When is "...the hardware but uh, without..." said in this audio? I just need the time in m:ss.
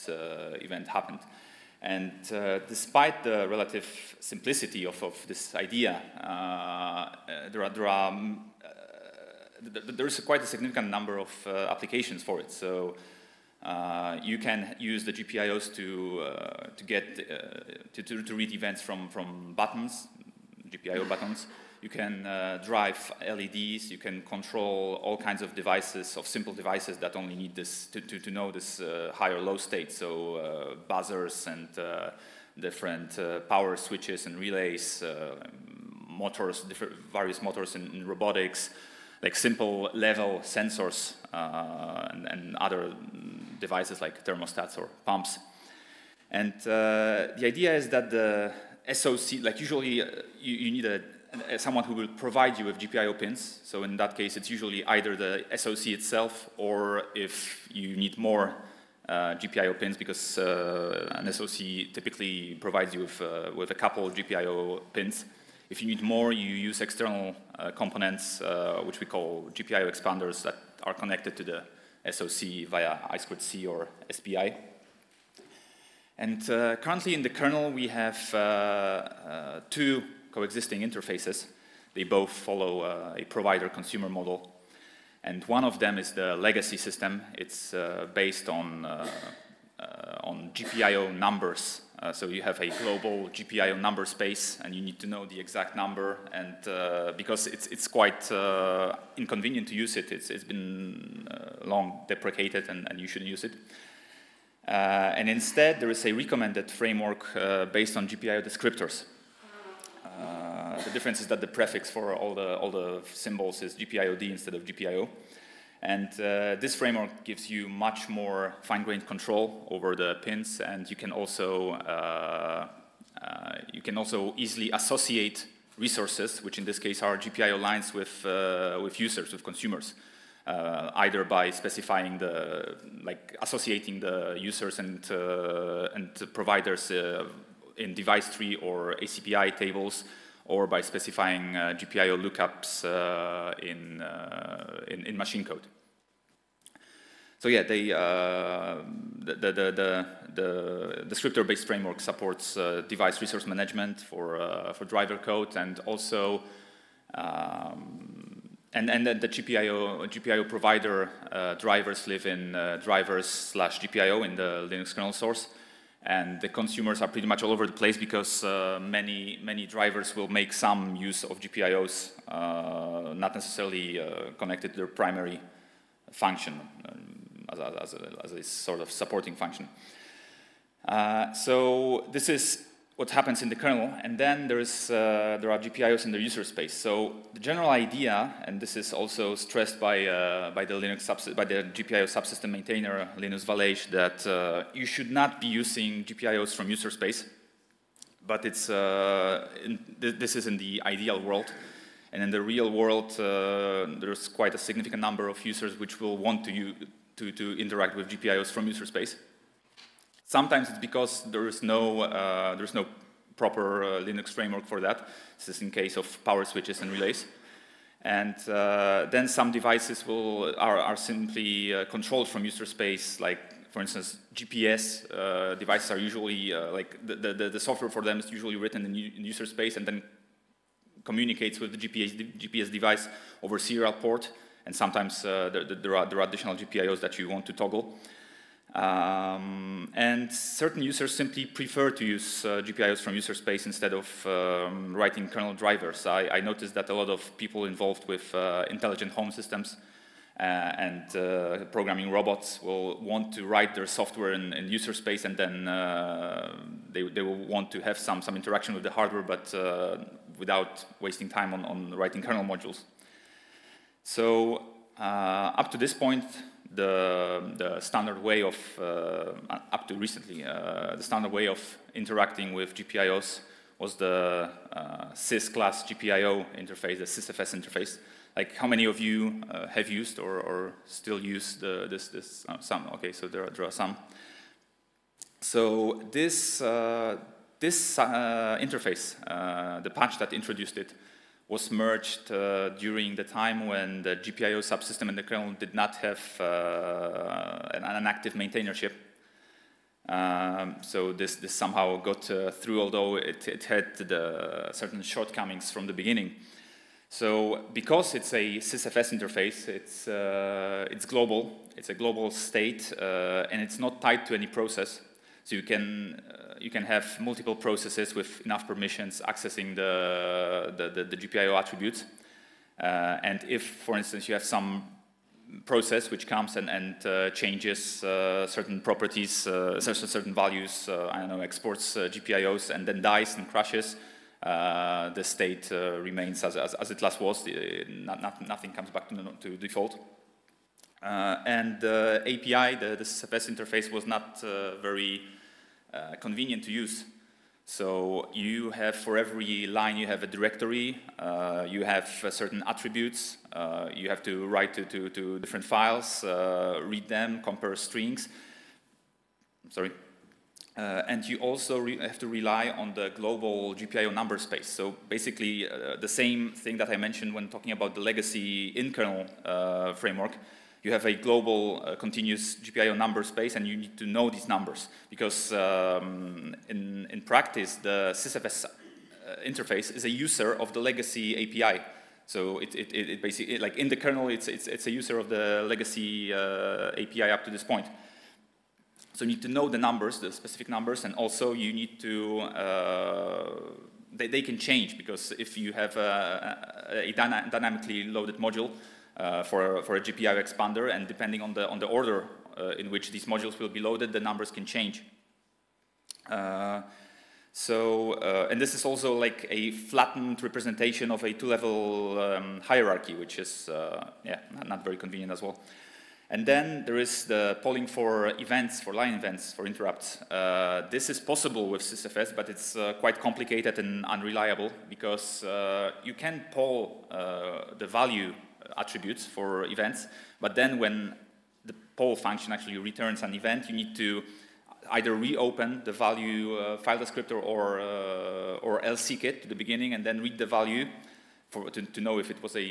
4:18.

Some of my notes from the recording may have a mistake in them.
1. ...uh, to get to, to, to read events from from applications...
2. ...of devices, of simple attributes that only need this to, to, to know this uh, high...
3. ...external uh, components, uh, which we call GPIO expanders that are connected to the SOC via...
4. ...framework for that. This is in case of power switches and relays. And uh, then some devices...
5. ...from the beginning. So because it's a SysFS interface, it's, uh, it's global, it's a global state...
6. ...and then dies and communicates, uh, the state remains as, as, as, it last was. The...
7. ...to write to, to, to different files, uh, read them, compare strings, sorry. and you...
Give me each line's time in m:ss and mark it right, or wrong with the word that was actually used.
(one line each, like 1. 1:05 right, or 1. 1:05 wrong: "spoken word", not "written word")
1. 0:16 wrong: "buttons", not "applications"
2. 0:25 wrong: "devices", not "attributes"
3. 1:06 right
4. 3:34 right
5. 5:05 right
6. 5:32 wrong: "crashes", not "communicates"
7. 5:54 right.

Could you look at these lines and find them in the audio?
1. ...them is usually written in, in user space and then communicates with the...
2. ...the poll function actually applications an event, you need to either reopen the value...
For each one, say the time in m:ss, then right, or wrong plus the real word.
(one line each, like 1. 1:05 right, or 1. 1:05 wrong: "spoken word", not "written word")
1. 3:48 right
2. 7:11 wrong: "returns", not "applications".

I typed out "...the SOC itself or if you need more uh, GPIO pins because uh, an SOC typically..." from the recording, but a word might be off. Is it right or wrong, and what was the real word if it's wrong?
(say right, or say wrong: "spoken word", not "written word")
right.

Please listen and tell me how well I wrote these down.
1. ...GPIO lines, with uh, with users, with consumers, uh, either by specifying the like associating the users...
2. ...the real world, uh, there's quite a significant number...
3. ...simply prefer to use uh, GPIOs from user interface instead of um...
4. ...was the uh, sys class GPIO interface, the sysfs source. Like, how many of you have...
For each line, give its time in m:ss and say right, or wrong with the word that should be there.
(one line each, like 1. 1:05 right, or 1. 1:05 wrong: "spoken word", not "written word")
1. 2:07 right
2. 3:22 right
3. 4:01 wrong: "space", not "interface"
4. 4:33 wrong: "interface", not "source".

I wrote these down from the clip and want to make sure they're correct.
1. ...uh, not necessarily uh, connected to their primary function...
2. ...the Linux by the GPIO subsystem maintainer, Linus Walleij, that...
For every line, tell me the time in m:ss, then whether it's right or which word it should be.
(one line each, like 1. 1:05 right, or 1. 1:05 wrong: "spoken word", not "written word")
1. 2:52 right
2. 3:10 right.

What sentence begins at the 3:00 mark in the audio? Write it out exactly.
Uh, so this is what happens in the kernel, and then there, is, uh, there are GPIOs in the user space.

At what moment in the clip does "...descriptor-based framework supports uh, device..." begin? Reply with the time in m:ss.
2:31.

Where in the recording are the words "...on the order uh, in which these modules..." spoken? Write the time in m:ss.
6:41.